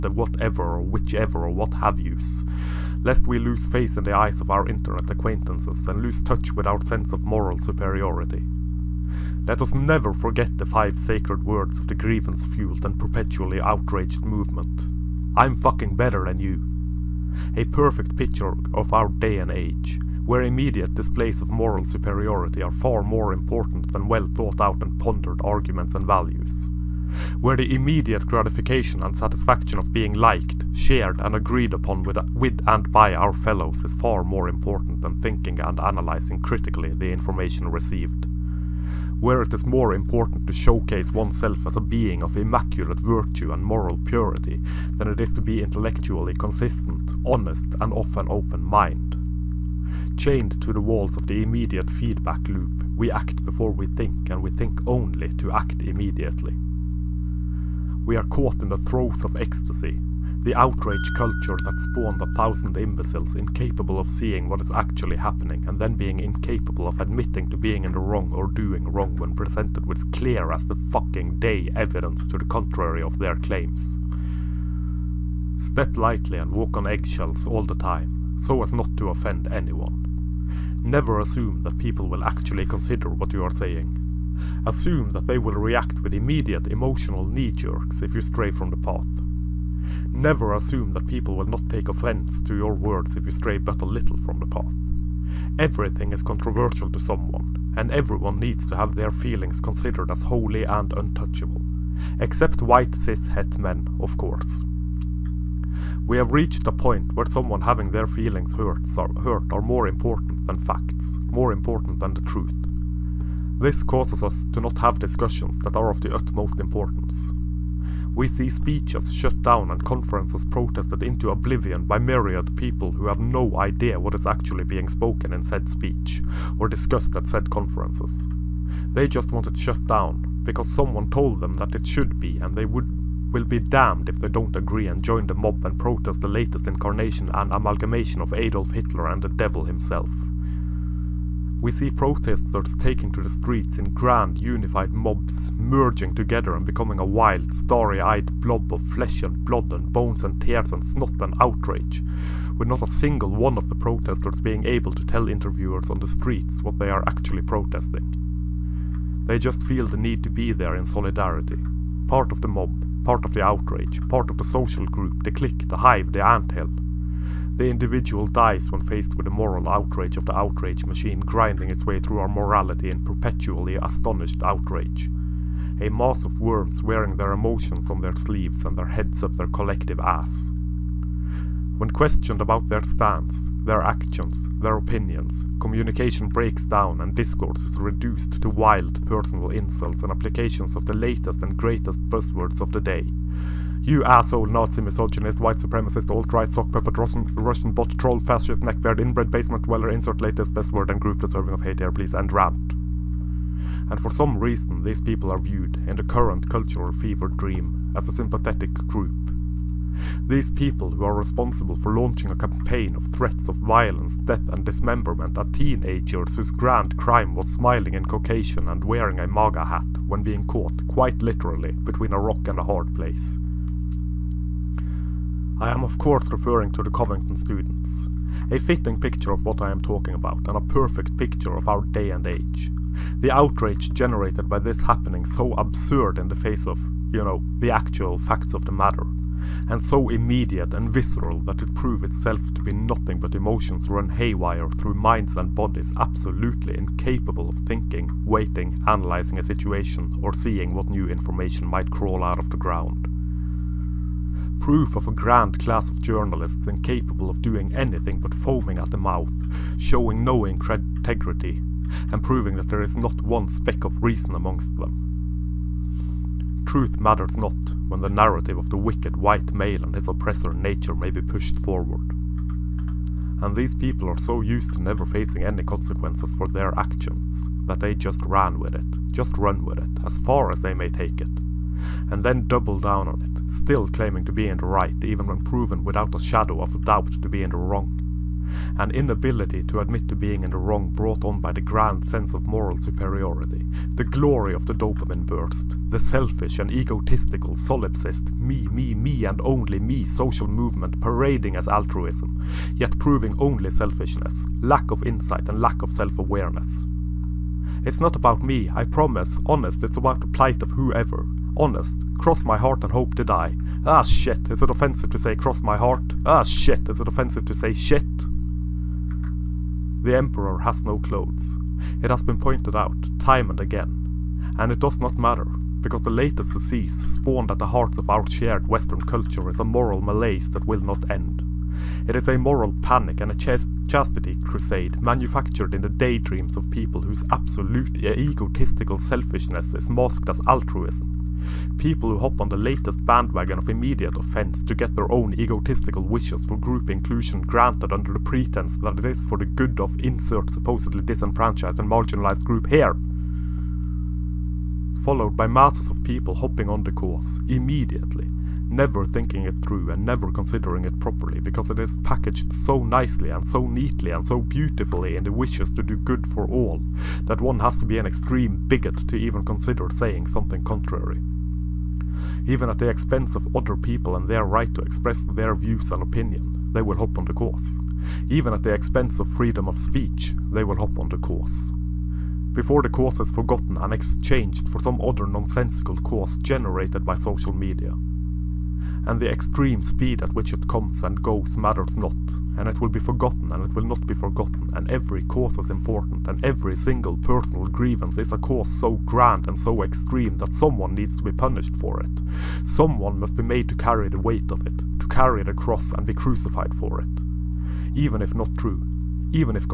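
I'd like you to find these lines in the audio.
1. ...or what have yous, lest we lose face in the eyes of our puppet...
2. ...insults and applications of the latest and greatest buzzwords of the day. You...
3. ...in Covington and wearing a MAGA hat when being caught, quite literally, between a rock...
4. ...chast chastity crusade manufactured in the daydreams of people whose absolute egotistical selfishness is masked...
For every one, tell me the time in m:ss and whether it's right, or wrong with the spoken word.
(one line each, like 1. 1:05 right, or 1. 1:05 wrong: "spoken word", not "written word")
1. 0:01 wrong: "internet", not "puppet"
2. 3:09 right
3. 3:37 wrong: "Caucasian", not "Covington"
4. 5:33 right.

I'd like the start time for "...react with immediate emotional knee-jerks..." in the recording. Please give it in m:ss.
1:25.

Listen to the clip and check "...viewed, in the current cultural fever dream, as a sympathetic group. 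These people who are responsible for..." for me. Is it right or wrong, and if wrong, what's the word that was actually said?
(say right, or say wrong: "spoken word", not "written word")
right.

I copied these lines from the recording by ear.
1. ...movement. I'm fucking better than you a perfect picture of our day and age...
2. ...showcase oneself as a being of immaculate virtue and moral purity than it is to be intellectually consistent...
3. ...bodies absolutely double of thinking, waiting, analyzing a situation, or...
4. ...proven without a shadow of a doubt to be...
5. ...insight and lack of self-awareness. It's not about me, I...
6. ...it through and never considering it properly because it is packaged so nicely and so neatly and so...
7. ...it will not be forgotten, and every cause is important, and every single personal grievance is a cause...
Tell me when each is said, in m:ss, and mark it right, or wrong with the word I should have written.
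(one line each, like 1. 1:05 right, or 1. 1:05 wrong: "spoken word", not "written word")
1. 0:14 right
2. 0:40 right
3. 4:05 wrong: "incapable", not "double"
4. 4:45 right
5. 5:05 right
6. 5:59 right
7. 6:33 right.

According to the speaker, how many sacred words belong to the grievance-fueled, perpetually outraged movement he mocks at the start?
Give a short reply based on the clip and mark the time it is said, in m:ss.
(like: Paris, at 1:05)
5, at 0:10.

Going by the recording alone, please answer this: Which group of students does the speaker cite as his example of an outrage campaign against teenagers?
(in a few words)
Covington students.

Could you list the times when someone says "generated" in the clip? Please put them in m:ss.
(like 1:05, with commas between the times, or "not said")
3:53, 6:26.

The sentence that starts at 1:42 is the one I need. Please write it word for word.
Except white cis het men, of course.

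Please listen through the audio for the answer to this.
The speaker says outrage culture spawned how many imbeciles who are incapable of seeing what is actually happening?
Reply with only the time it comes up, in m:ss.
1:02.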